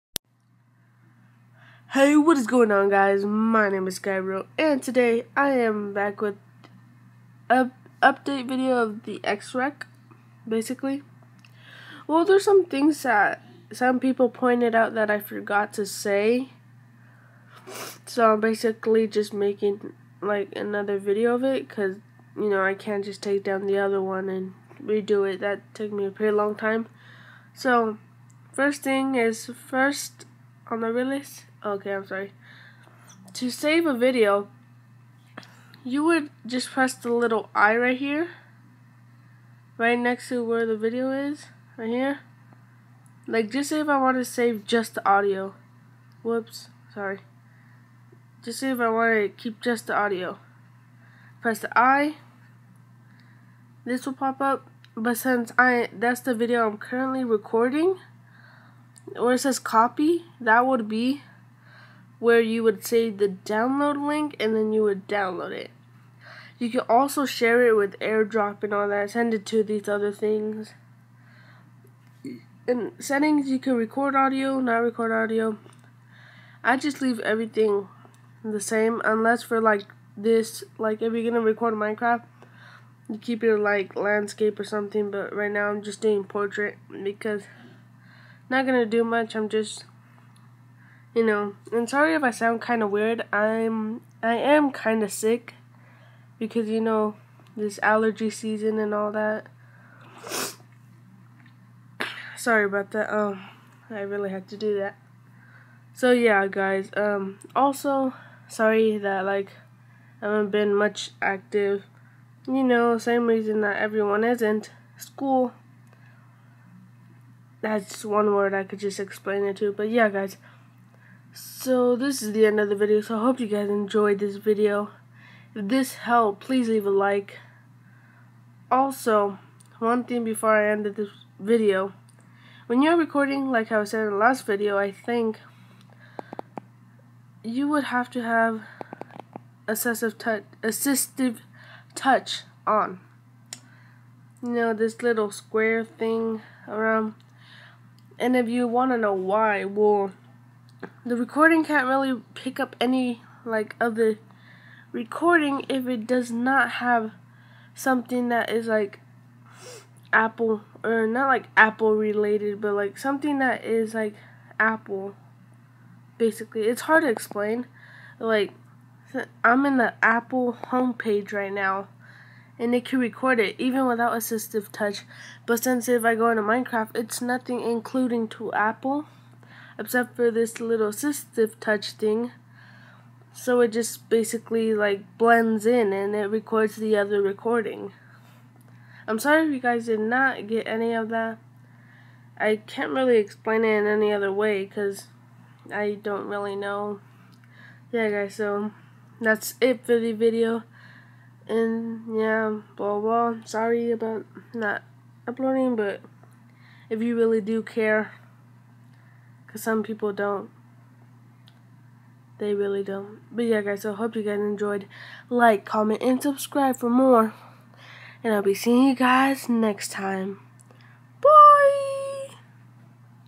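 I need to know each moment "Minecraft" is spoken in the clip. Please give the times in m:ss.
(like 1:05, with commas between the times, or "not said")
1:21, 2:56.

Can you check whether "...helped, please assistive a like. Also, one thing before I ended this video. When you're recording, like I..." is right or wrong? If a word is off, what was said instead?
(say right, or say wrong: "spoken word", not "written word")
wrong: "leave", not "assistive".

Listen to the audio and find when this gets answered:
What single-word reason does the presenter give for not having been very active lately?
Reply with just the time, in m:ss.
1:54.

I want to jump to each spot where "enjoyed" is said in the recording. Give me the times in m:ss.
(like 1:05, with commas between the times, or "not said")
2:03, 3:34.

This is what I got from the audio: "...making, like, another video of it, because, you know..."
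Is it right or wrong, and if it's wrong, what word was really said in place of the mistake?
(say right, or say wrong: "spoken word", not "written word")
right.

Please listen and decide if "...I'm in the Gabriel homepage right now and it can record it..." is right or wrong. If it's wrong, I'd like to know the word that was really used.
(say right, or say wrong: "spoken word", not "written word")
wrong: "Apple", not "Gabriel".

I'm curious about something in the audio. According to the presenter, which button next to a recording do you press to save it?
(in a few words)
The I.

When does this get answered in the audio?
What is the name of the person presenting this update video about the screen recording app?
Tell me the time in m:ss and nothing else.
0:03.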